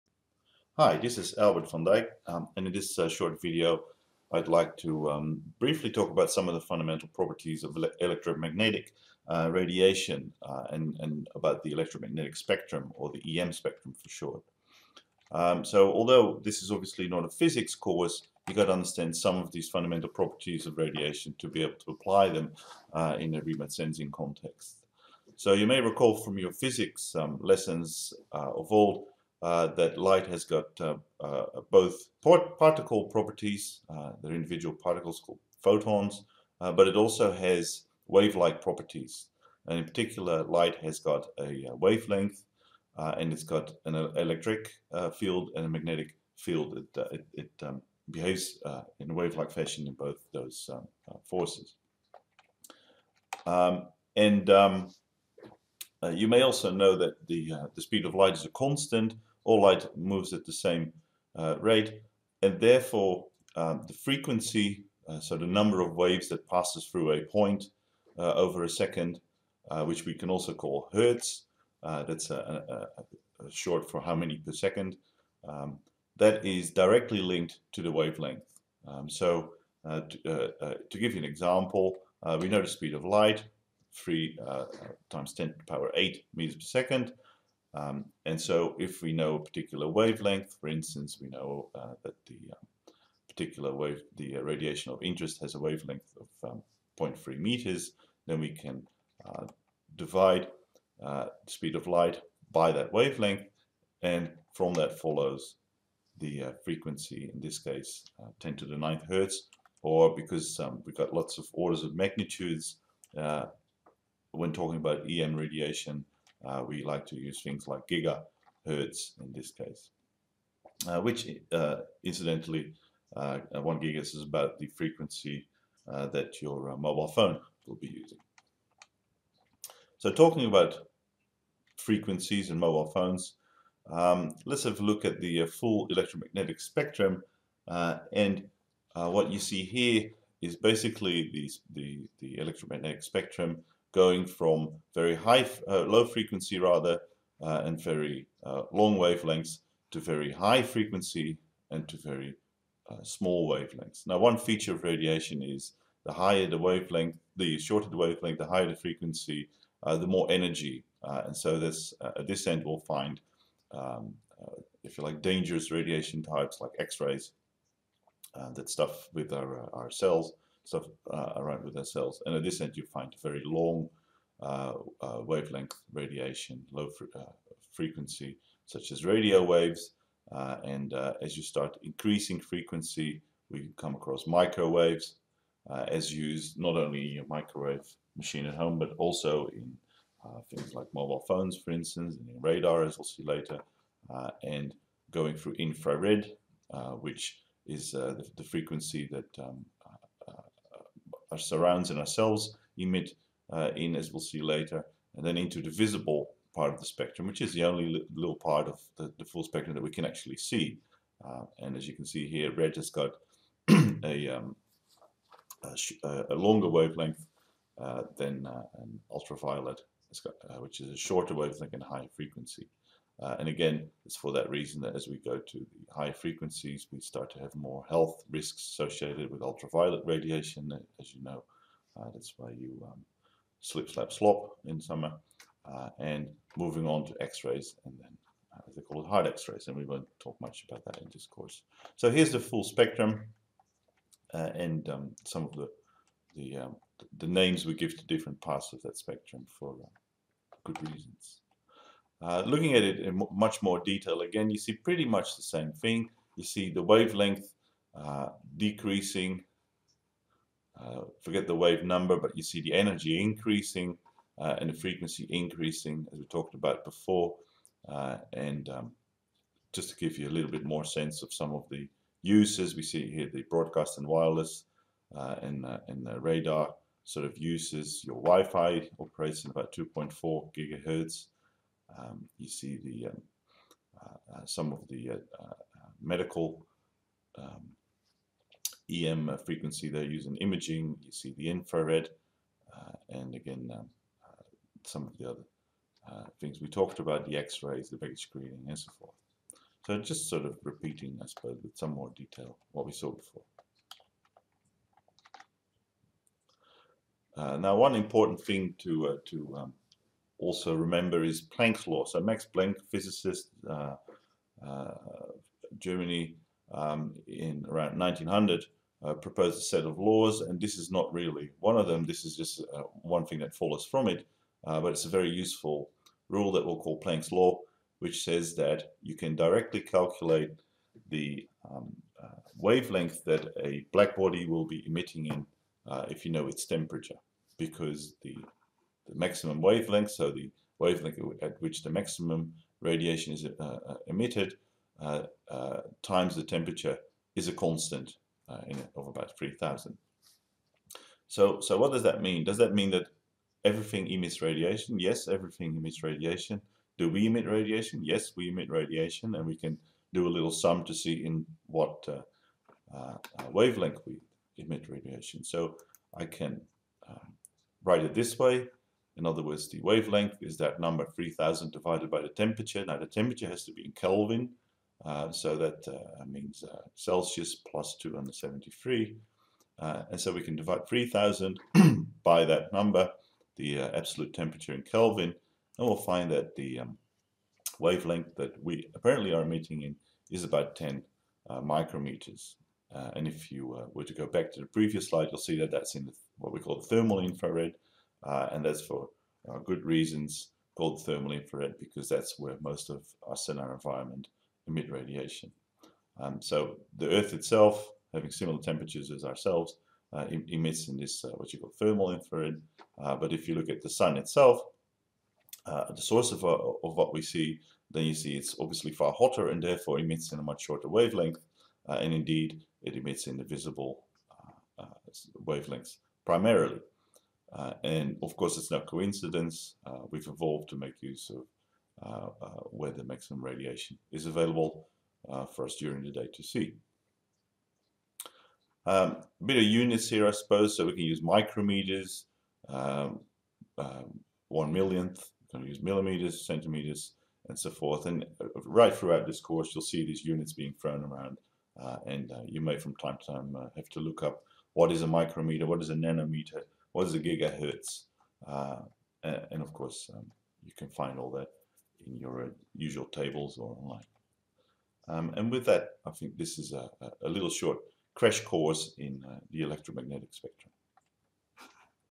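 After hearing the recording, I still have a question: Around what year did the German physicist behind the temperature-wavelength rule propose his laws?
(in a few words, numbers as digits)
1900.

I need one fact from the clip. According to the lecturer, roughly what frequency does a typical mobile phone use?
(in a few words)
1 gigahertz.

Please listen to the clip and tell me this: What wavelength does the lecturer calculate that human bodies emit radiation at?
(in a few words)
10 micrometers.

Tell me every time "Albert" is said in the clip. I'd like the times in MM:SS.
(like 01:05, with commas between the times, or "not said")
00:01.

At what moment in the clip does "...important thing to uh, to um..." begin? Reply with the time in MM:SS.
05:07.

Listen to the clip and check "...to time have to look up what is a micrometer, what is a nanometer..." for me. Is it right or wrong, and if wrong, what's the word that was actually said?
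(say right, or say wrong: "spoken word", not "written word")
right.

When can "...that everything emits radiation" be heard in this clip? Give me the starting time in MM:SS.
05:52.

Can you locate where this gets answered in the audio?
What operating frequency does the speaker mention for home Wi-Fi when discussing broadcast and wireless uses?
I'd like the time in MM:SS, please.
04:39.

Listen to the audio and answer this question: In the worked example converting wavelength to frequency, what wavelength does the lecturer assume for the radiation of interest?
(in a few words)
0.3 meters.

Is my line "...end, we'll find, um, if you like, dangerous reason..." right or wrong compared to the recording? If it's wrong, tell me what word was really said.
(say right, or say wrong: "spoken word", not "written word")
wrong: "radiation", not "reason".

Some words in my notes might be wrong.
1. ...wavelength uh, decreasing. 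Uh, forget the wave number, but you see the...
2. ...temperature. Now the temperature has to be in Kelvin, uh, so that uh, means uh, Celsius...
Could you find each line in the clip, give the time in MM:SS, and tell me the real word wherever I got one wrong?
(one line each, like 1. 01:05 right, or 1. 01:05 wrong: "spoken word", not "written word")
1. 04:16 right
2. 06:12 right.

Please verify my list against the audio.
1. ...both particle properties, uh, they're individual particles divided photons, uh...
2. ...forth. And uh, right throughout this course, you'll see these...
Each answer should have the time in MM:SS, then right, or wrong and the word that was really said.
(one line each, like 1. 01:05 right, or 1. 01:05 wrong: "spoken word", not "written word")
1. 00:31 wrong: "called", not "divided"
2. 07:27 right.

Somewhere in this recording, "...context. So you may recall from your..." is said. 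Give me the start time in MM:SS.
00:24.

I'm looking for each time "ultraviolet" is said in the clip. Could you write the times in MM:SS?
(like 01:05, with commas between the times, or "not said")
03:39, 03:49.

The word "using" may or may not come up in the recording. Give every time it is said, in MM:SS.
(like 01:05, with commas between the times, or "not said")
02:07, 04:50.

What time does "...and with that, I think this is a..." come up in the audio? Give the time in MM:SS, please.
07:45.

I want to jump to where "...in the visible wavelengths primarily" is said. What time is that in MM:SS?
07:03.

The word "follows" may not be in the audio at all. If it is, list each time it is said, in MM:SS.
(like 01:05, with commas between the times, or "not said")
01:44, 05:23.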